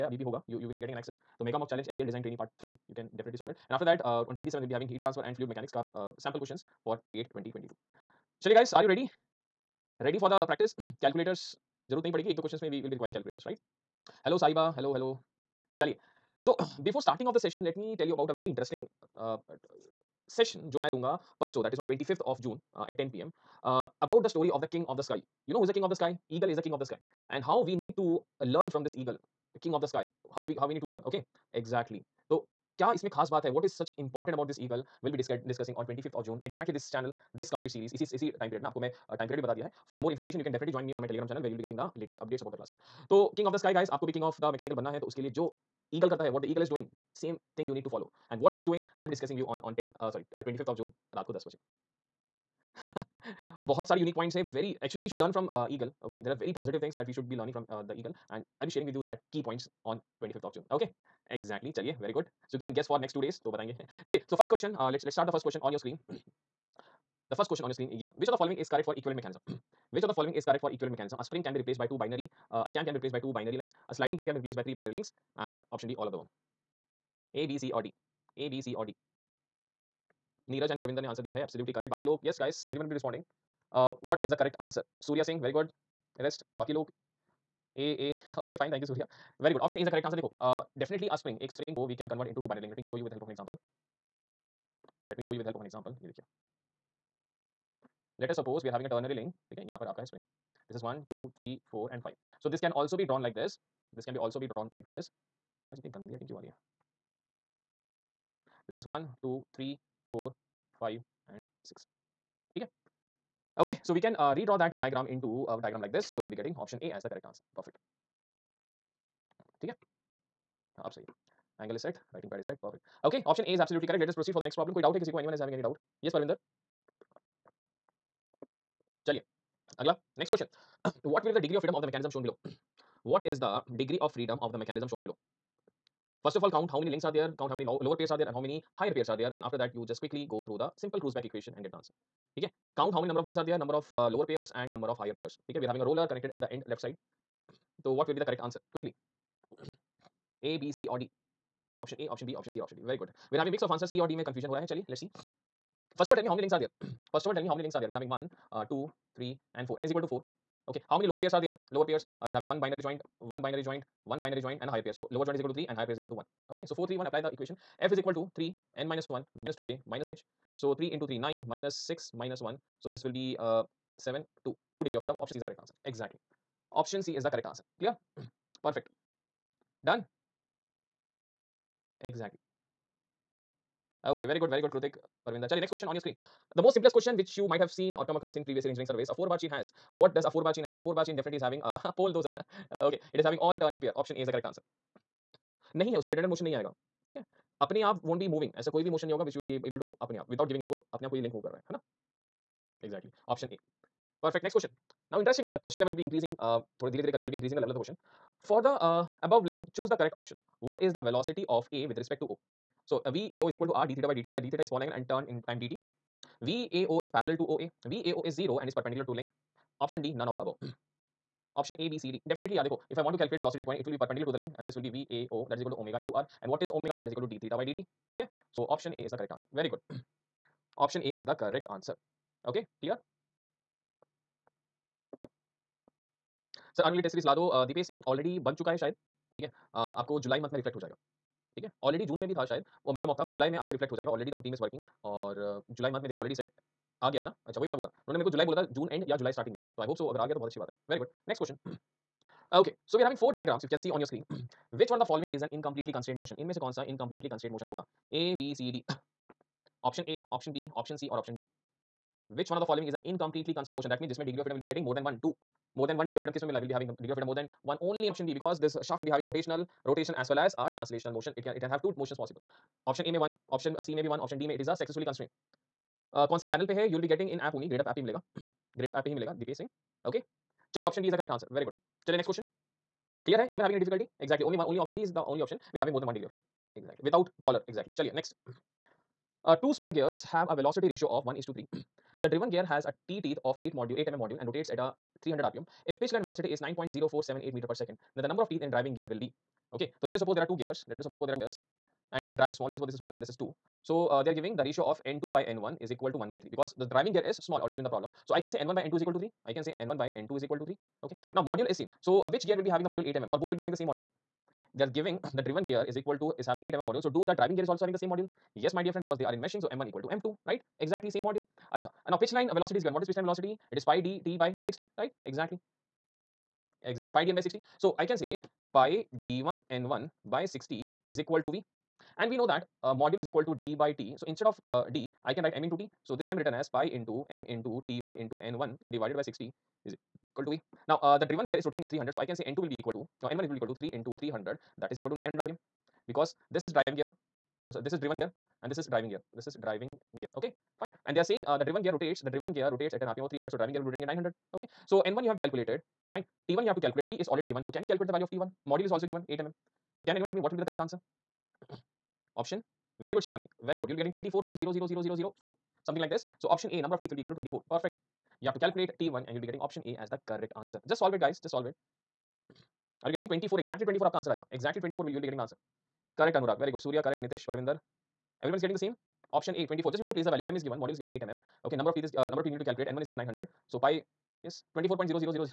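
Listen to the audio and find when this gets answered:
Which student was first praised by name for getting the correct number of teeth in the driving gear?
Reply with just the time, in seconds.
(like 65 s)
363 s.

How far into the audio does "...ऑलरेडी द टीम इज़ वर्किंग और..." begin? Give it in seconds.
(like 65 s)
244 s.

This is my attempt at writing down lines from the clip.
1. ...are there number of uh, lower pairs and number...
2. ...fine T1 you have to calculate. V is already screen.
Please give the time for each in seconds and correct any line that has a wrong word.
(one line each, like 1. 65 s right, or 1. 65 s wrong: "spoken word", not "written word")
1. 143 s right
2. 356 s wrong: "given", not "screen".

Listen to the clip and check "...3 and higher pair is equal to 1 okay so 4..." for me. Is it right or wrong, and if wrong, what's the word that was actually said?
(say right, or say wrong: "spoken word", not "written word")
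right.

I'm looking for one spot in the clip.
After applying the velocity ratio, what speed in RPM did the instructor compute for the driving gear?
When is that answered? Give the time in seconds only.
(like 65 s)
345 s.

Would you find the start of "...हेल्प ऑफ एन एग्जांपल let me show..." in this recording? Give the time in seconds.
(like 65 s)
93 s.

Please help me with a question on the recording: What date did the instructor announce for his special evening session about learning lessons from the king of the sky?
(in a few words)
25th June.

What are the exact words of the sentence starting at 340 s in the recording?
Now, uh, the driven gear is rotating at 300.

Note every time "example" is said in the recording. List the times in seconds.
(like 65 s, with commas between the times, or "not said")
95 s.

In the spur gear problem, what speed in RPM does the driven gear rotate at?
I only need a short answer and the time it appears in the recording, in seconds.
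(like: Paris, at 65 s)
300 RPM, at 295 s.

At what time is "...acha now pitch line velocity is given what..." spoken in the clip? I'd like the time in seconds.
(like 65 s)
321 s.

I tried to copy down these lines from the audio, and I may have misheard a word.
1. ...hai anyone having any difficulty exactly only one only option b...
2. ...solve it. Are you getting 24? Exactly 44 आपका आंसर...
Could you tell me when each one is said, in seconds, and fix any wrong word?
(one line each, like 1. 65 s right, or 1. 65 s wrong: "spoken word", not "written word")
1. 283 s right
2. 371 s wrong: "24", not "44".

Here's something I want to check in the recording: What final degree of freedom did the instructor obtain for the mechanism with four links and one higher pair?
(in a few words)
2.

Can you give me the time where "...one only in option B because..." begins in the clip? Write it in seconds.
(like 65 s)
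267 s.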